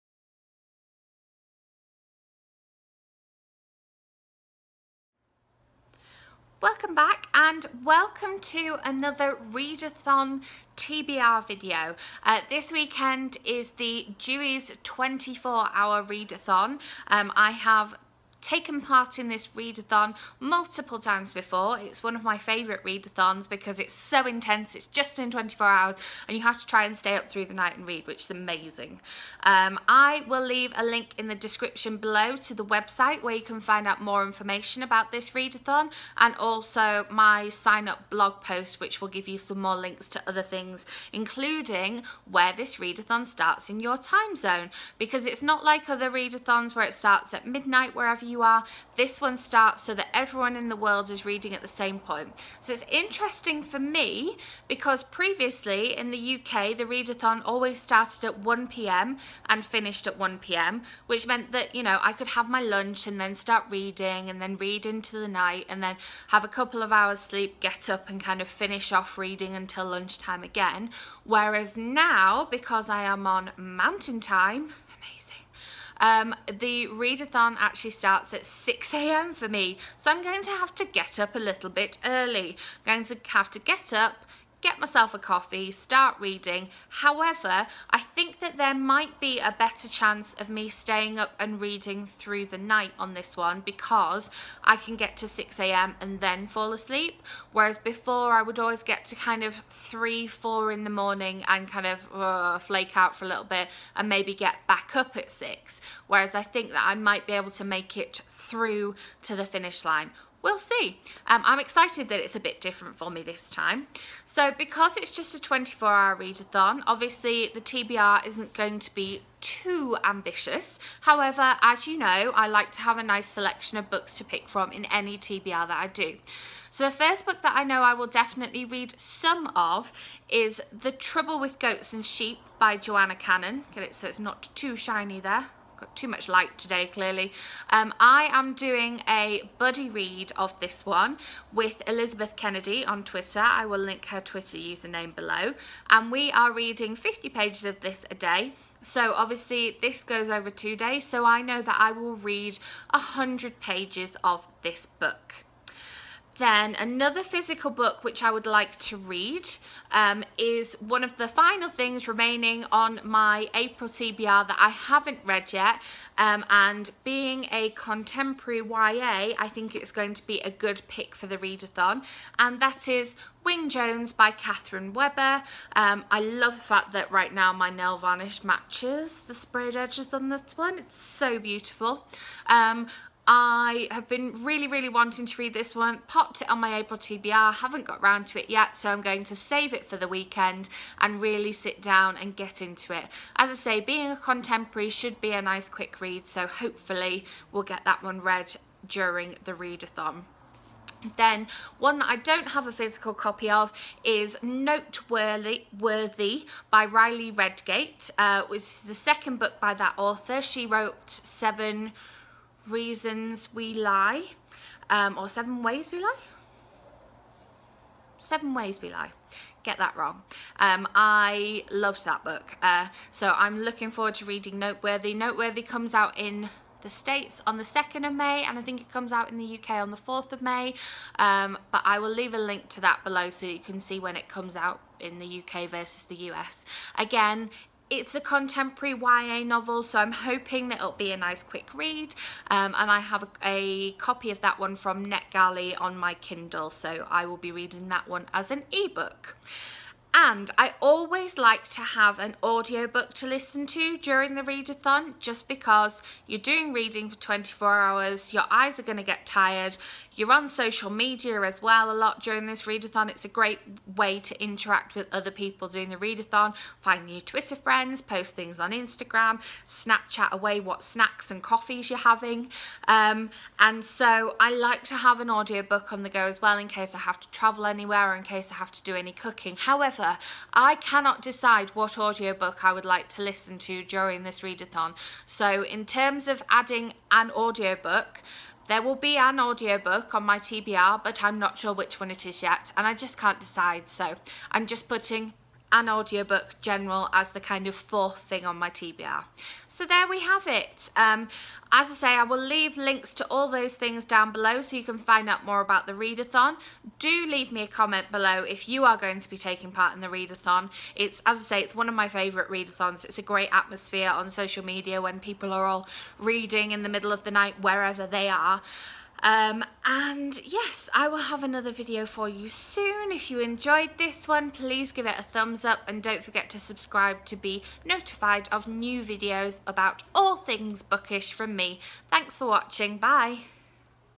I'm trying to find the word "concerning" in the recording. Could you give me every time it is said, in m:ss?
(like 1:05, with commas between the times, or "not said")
not said.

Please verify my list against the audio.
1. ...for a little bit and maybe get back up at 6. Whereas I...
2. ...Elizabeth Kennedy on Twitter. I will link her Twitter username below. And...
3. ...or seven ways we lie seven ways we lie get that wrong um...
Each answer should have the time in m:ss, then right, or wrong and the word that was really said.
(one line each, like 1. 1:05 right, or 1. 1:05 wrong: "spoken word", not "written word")
1. 1:43 right
2. 2:21 right
3. 3:35 right.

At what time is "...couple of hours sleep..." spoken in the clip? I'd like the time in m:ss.
1:06.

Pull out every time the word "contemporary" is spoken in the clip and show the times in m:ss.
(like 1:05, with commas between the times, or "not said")
2:47, 3:14, 3:58.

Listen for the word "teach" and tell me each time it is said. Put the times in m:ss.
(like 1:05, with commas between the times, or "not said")
not said.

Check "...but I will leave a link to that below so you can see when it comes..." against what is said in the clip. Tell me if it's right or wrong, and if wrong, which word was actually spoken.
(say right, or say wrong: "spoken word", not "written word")
right.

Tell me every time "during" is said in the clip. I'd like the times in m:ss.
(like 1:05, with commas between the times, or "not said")
3:18, 4:13, 4:22, 4:43.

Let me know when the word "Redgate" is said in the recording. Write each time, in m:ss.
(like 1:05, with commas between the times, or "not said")
3:27.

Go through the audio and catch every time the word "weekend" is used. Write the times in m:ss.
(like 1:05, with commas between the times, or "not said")
0:12, 3:10.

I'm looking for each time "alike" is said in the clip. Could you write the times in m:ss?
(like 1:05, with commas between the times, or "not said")
not said.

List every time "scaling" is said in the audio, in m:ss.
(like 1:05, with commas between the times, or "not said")
not said.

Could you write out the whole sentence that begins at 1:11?
Whereas now, because I am on mountain time, um, the readathon actually starts at 6 a.m.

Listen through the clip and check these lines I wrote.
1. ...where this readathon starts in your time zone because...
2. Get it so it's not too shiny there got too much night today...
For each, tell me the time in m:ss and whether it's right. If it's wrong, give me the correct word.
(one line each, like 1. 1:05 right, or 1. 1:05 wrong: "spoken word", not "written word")
1. 0:42 right
2. 2:13 wrong: "light", not "night".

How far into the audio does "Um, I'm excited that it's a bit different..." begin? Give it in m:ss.
1:51.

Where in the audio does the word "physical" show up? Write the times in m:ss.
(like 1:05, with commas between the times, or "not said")
2:37, 3:22.